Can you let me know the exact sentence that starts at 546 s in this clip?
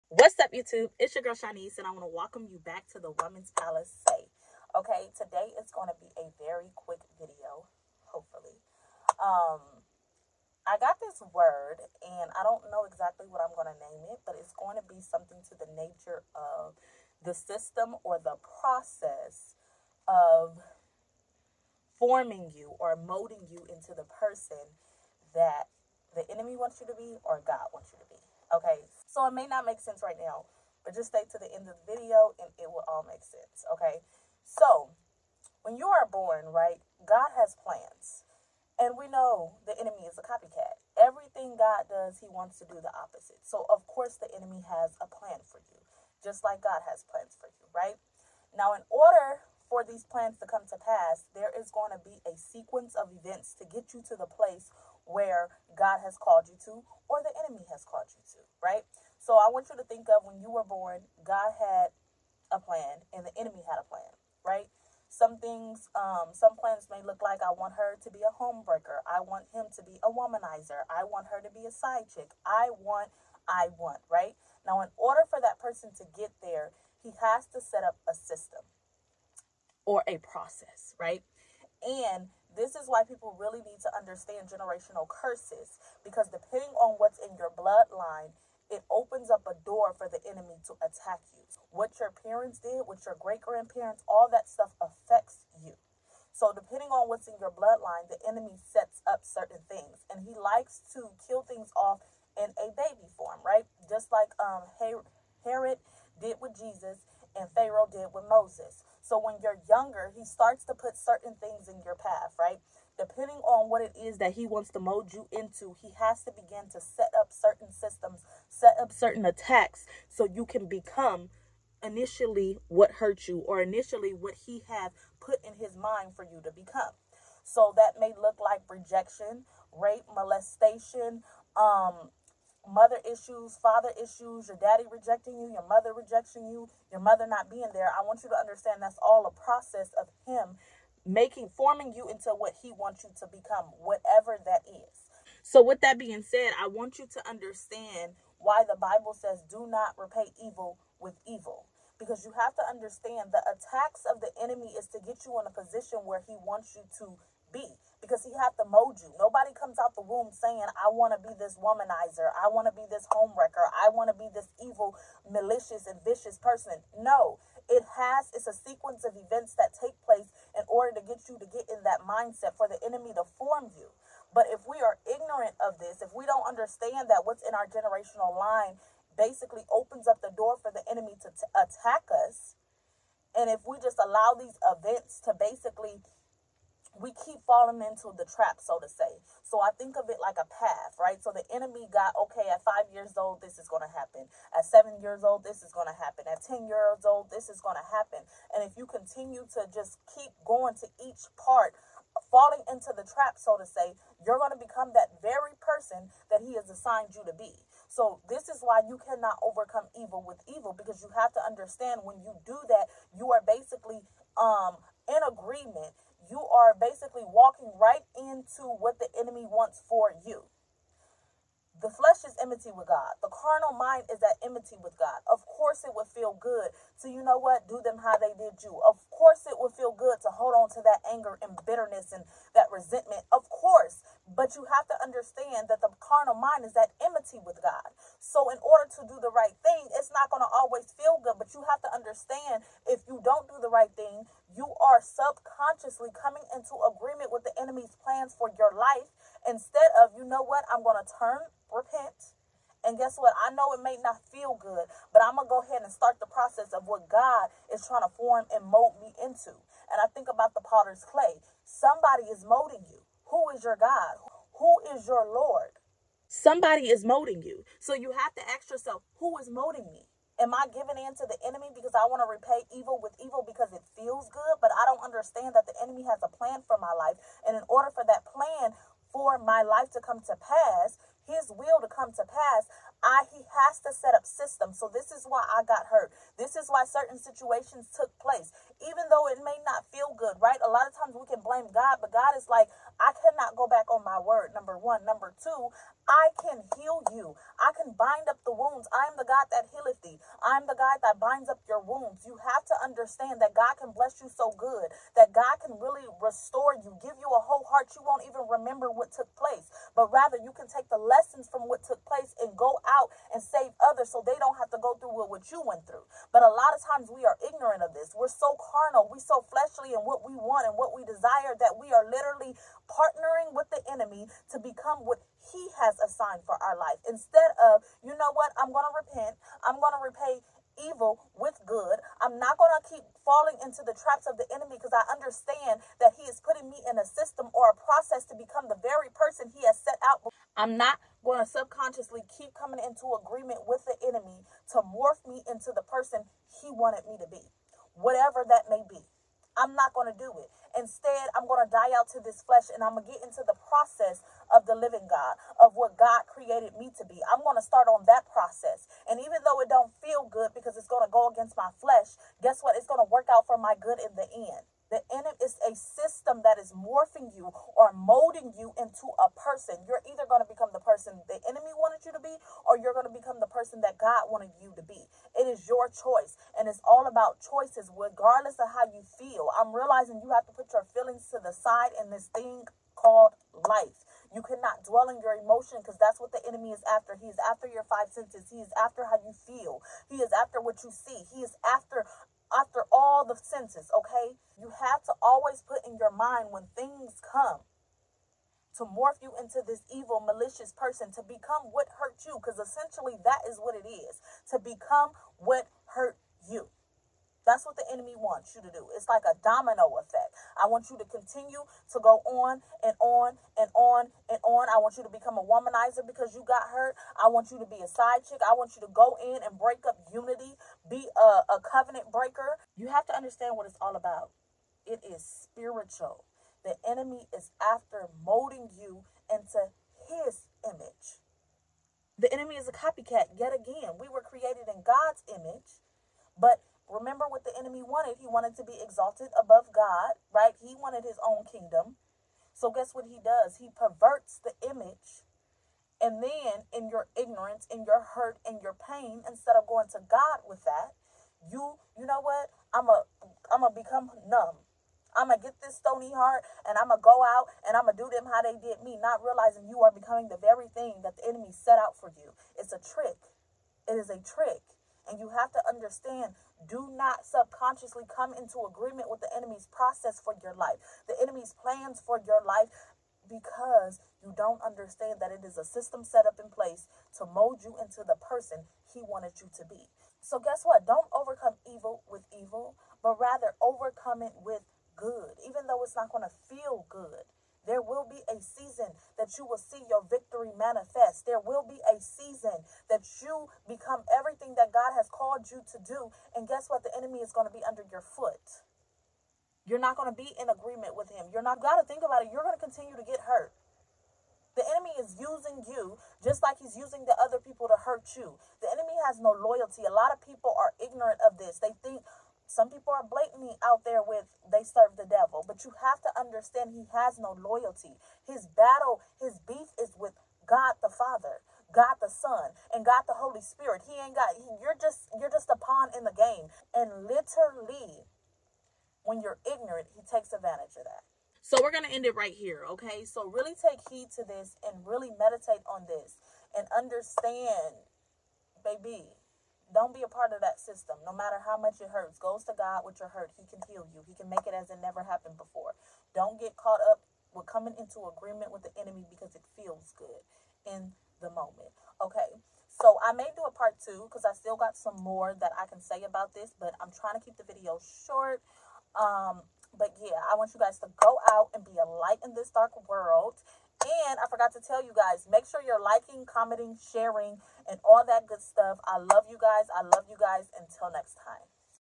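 Don't get caught up with coming into agreement with the enemy because it feels good in the moment.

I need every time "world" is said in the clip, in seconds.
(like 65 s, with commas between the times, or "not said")
562 s.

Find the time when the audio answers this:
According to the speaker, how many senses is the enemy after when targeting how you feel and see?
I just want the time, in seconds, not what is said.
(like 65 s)
387 s.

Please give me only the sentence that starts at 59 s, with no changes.
So I want you to think of when you were born, God had a plan and the enemy had a plan, right?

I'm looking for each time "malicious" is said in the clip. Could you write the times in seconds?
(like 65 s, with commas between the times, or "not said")
165 s, 400 s.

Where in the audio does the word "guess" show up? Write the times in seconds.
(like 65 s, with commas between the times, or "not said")
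252 s, 362 s, 442 s, 480 s, 496 s.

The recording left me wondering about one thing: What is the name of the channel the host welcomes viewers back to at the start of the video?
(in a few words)
Women's Palace Say.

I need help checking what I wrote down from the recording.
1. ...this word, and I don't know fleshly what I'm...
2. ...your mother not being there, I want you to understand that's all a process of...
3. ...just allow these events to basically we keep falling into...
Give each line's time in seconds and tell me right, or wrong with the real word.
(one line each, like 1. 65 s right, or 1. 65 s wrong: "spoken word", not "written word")
1. 11 s wrong: "exactly", not "fleshly"
2. 136 s right
3. 183 s right.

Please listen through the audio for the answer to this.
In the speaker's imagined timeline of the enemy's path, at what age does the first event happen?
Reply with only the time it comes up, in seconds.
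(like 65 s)
192 s.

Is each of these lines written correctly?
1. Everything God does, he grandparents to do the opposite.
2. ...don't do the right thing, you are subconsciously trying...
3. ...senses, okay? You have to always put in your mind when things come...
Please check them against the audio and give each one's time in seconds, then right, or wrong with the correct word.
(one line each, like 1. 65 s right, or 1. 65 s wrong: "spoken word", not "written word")
1. 40 s wrong: "wants", not "grandparents"
2. 243 s wrong: "coming", not "trying"
3. 393 s right.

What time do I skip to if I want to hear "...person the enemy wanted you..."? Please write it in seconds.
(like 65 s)
370 s.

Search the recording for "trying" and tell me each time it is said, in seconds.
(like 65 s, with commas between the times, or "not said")
257 s, 556 s.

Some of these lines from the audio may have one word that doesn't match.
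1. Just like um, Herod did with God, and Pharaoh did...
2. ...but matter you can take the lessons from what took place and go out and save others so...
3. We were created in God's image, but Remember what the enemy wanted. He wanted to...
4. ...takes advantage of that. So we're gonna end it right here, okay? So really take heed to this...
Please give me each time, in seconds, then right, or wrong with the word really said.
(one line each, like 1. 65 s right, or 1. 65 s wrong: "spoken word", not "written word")
1. 103 s wrong: "Jesus", not "God"
2. 309 s wrong: "rather", not "matter"
3. 433 s right
4. 530 s right.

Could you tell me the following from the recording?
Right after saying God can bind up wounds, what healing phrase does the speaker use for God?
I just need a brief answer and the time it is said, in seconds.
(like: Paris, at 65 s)
The God that healeth thee, at 299 s.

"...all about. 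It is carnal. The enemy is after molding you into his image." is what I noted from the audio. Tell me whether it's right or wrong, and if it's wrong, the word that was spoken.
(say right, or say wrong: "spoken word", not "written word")
wrong: "spiritual", not "carnal".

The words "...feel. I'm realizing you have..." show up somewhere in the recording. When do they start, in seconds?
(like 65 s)
379 s.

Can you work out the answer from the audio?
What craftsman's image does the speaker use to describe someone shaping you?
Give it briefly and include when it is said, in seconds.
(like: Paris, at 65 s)
The potter's clay, at 260 s.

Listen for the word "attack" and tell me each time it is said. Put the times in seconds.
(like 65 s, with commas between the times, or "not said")
90 s, 119 s, 153 s, 181 s.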